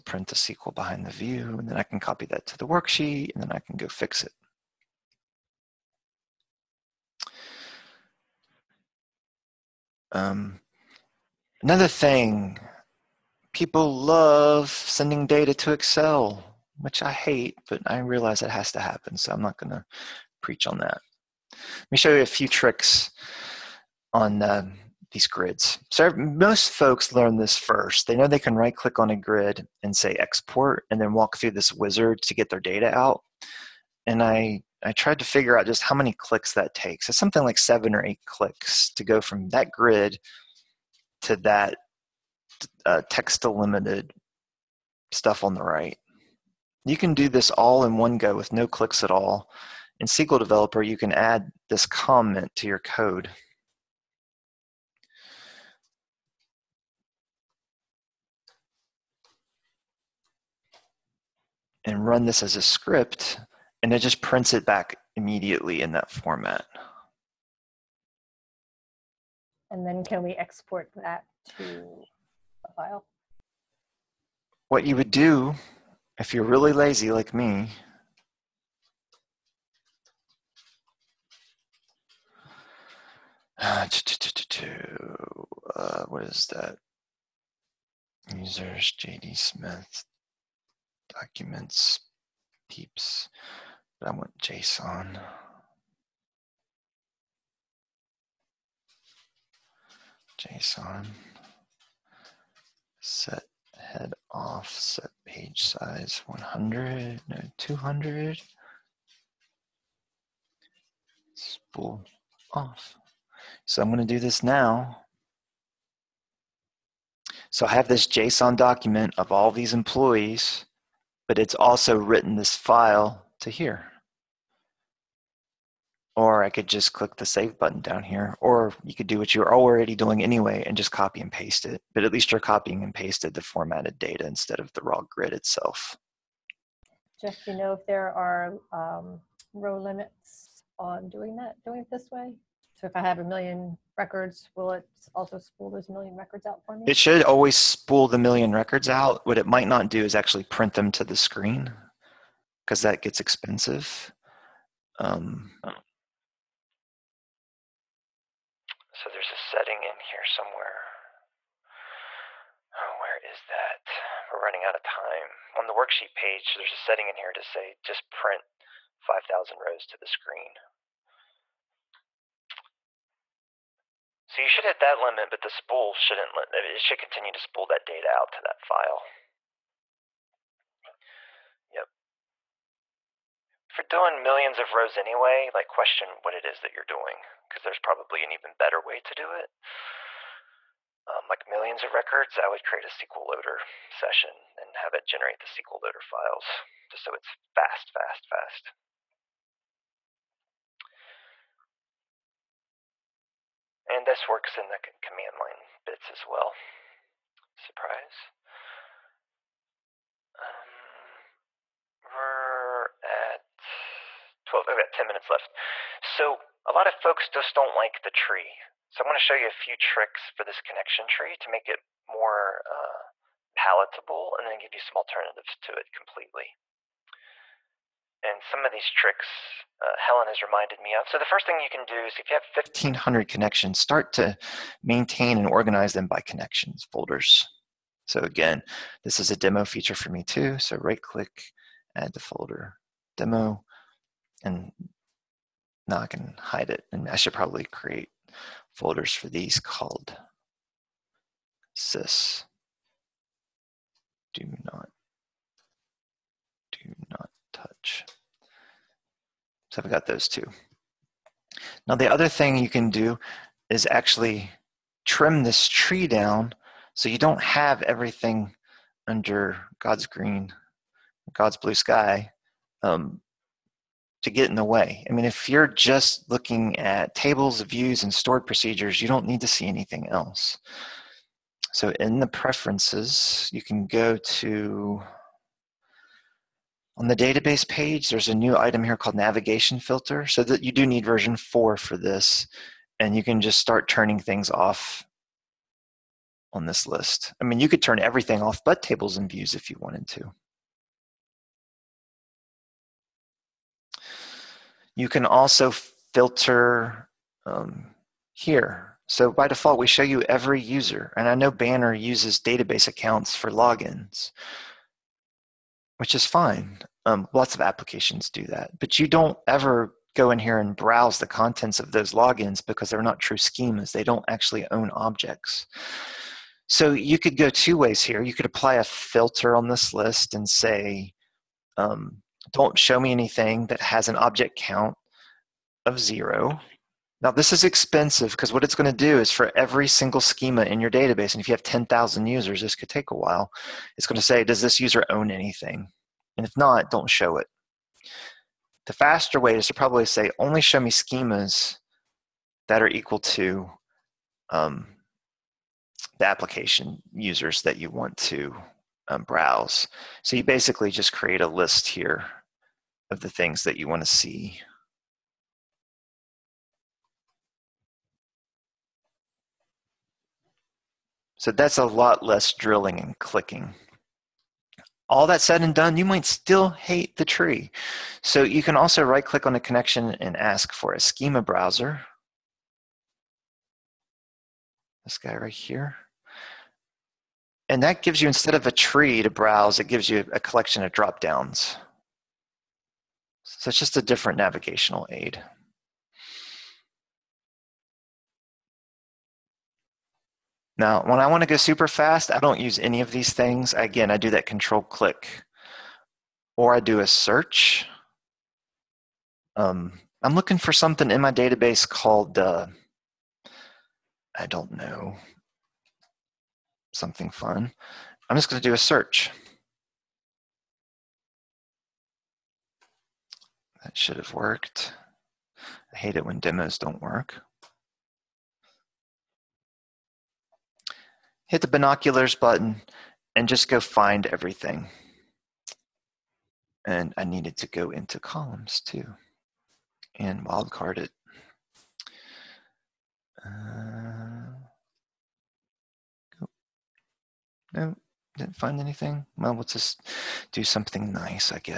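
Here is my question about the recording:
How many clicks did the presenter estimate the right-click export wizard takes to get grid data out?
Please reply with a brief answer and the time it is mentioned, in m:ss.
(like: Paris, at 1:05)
7 or 8, at 0:37.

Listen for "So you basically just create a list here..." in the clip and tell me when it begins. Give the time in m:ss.
6:00.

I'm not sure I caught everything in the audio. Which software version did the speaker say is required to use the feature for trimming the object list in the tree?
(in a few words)
version 4.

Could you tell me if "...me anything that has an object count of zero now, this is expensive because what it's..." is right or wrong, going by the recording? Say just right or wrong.
right.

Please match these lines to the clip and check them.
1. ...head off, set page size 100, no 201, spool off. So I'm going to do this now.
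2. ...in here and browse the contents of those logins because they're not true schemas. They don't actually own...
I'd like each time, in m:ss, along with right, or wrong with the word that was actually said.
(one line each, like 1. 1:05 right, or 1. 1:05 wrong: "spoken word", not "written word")
1. 1:43 wrong: "200", not "201"
2. 5:20 right.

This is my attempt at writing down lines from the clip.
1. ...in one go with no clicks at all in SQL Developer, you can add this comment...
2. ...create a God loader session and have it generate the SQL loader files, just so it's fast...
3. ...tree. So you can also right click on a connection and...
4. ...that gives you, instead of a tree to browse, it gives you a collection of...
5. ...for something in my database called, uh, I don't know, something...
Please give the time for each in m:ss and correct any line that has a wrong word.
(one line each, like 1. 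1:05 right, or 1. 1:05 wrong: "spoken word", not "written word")
1. 0:47 right
2. 3:12 wrong: "SQL", not "God"
3. 6:17 right
4. 6:27 right
5. 6:50 right.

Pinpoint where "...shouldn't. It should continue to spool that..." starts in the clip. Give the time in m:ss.
2:55.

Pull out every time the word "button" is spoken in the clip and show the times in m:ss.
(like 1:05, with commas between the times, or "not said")
2:07, 7:12.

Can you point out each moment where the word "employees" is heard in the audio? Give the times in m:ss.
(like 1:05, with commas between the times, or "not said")
1:59.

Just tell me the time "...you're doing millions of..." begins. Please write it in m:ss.
3:03.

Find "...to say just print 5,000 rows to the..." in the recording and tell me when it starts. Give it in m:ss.
2:47.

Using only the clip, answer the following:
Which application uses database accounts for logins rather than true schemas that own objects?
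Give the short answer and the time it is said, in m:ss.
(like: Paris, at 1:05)
Banner, at 5:11.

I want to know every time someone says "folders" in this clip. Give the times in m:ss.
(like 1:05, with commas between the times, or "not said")
3:56, 4:02, 4:08.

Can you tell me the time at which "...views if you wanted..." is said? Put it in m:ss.
4:59.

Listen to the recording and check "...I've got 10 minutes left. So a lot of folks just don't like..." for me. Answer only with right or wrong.
right.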